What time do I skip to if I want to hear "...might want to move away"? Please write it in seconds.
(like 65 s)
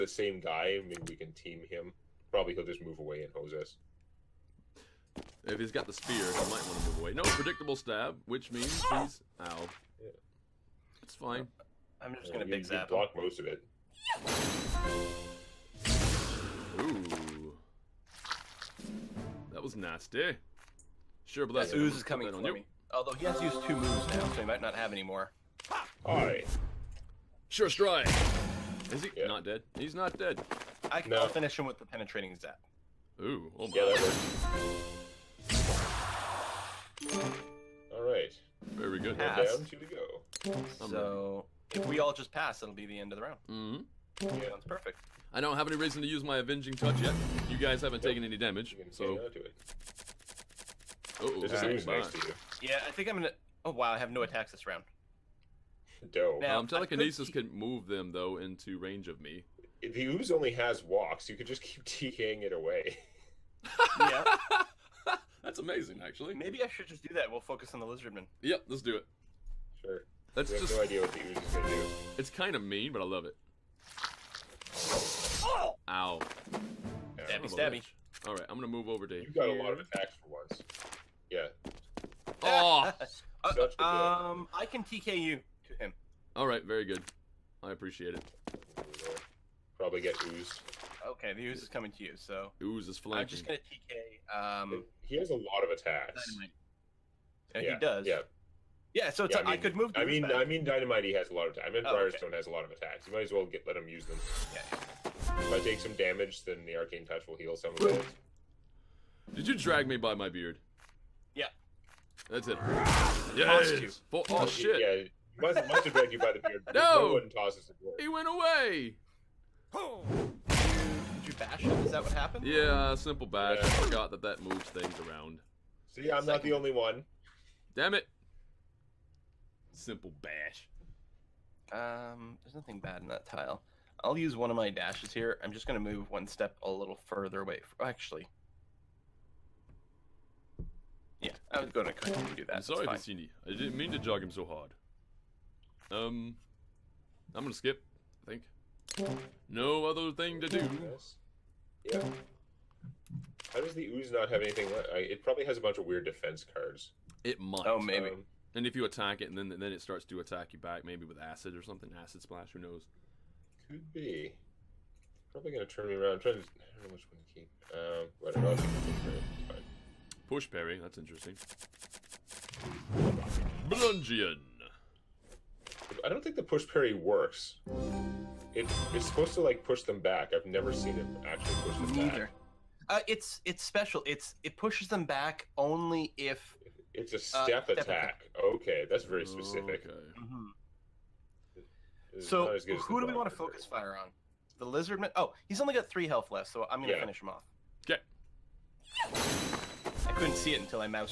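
6 s.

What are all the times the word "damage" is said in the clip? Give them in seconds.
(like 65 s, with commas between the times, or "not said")
48 s, 105 s.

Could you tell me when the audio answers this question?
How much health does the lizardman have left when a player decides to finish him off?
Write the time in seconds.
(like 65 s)
195 s.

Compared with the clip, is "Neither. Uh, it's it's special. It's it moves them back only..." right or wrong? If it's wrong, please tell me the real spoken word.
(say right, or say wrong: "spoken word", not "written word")
wrong: "pushes", not "moves".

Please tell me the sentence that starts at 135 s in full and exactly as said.
I'm just going to move one step a little further away.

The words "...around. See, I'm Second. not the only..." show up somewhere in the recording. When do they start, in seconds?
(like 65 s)
125 s.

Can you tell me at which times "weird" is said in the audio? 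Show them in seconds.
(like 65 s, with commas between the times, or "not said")
155 s.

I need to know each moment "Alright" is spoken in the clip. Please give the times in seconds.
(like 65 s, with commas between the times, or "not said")
26 s, 37 s.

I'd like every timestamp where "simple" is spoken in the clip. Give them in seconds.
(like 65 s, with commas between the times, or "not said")
122 s, 129 s.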